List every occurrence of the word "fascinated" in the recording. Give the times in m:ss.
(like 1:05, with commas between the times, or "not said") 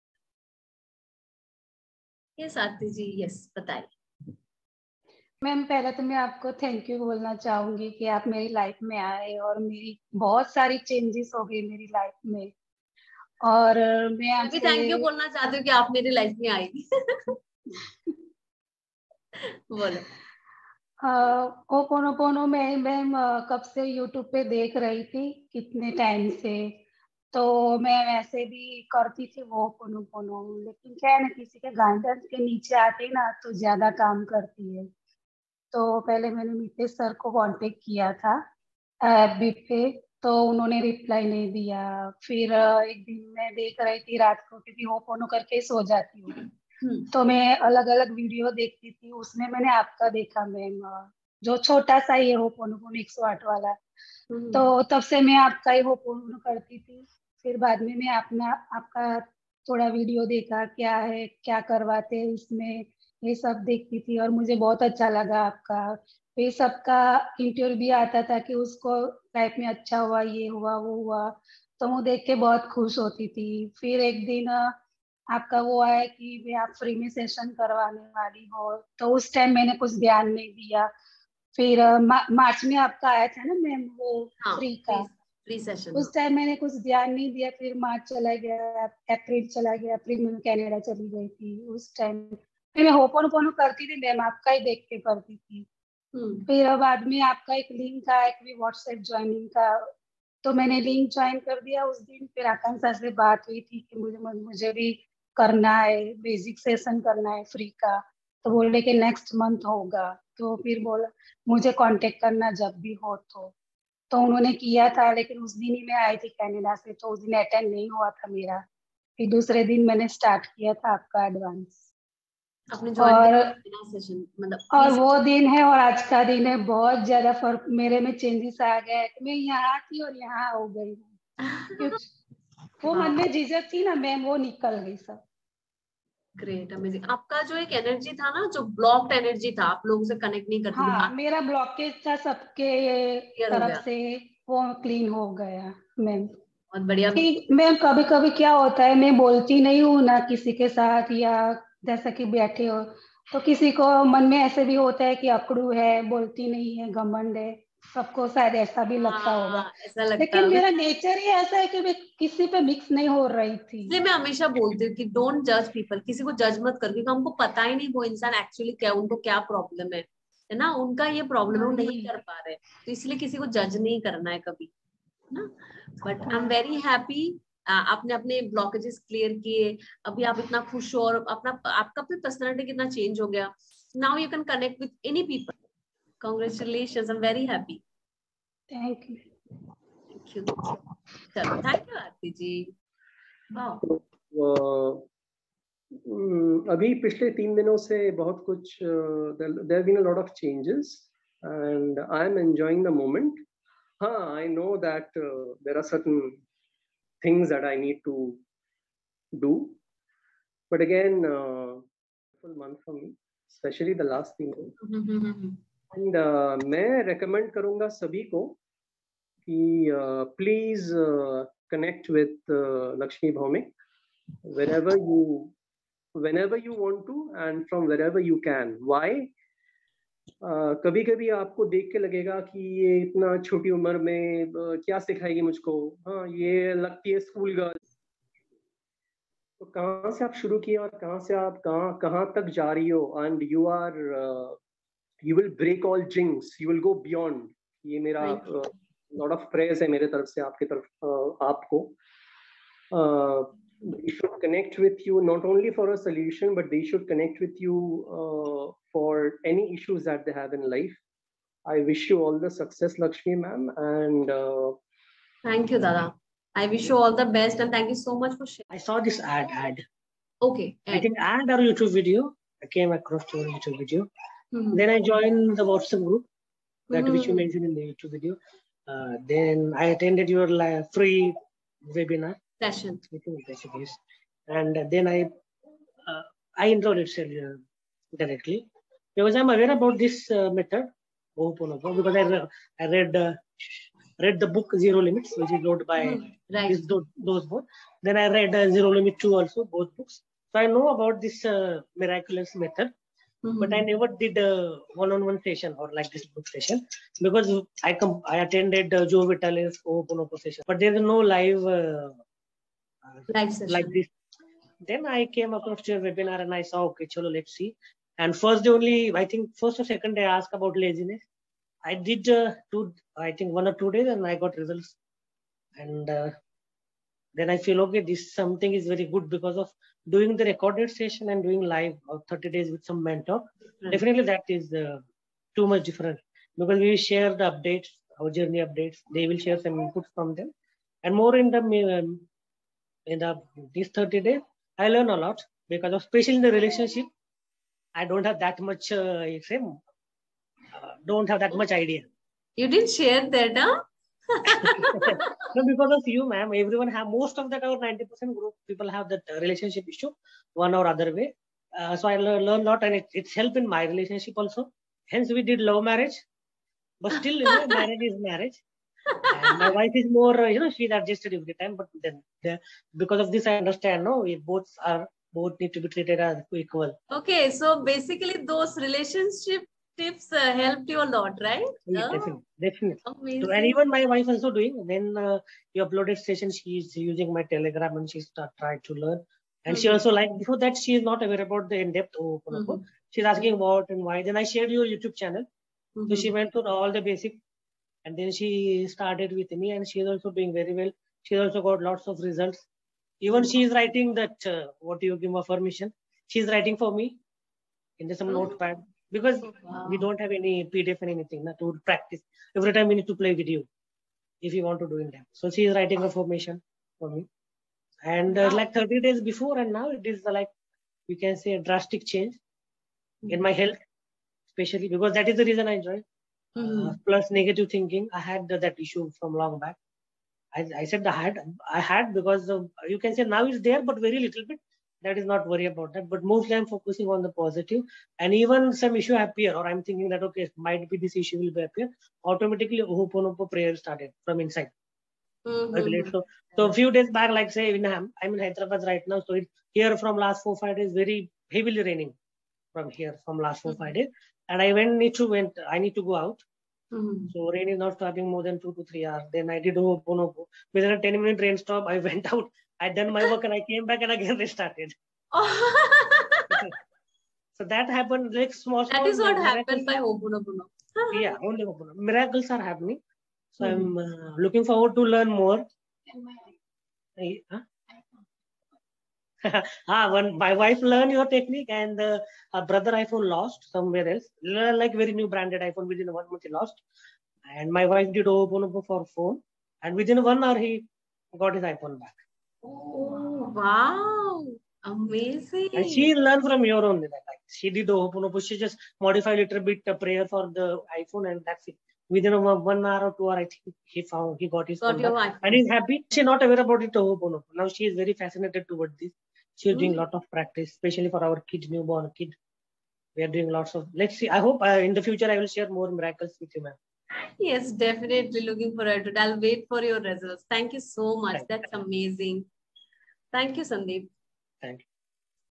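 8:28.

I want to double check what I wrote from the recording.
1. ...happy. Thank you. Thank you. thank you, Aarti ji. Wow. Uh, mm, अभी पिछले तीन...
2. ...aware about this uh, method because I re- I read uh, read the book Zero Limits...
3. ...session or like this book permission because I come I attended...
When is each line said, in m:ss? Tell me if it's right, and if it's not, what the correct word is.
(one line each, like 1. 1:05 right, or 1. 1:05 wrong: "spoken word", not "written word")
1. 3:07 right
2. 4:49 right
3. 5:05 wrong: "session", not "permission".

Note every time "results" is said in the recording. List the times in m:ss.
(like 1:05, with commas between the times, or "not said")
5:24, 6:42, 8:40.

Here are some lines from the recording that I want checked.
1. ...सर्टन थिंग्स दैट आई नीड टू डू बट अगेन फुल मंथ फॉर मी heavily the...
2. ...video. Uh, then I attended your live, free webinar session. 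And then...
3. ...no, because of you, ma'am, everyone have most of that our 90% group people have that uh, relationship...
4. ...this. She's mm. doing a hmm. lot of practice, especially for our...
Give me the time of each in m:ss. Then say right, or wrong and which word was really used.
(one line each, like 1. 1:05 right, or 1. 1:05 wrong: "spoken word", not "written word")
1. 3:25 wrong: "especially", not "heavily"
2. 4:38 right
3. 5:55 right
4. 8:28 right.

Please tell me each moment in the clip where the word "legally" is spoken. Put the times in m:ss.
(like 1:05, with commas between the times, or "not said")
not said.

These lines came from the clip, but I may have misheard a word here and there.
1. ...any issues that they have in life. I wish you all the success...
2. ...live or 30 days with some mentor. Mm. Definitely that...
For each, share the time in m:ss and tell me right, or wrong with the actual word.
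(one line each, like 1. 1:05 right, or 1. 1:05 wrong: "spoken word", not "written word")
1. 4:19 right
2. 5:31 right.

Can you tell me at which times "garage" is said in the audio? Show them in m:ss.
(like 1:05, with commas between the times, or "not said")
not said.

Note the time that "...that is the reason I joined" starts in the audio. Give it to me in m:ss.
7:05.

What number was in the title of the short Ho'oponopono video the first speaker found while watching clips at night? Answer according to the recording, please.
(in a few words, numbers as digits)
108.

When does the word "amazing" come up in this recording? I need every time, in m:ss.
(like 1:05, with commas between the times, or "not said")
6:23, 8:14, 8:41.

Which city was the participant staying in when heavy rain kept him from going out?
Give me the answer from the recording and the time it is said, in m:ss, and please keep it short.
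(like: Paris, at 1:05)
Hyderabad, at 7:28.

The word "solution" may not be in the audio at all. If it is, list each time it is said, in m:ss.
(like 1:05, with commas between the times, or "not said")
4:16.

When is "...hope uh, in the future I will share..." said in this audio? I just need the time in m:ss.
8:34.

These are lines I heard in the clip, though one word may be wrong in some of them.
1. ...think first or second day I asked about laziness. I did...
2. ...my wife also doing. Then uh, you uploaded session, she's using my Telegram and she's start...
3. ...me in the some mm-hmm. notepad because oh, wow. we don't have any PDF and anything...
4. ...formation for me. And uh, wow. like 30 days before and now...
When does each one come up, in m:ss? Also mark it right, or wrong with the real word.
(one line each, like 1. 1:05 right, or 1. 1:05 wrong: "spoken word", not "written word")
1. 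5:19 right
2. 6:23 right
3. 6:46 right
4. 6:56 right.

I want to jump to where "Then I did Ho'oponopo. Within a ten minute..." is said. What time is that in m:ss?
7:39.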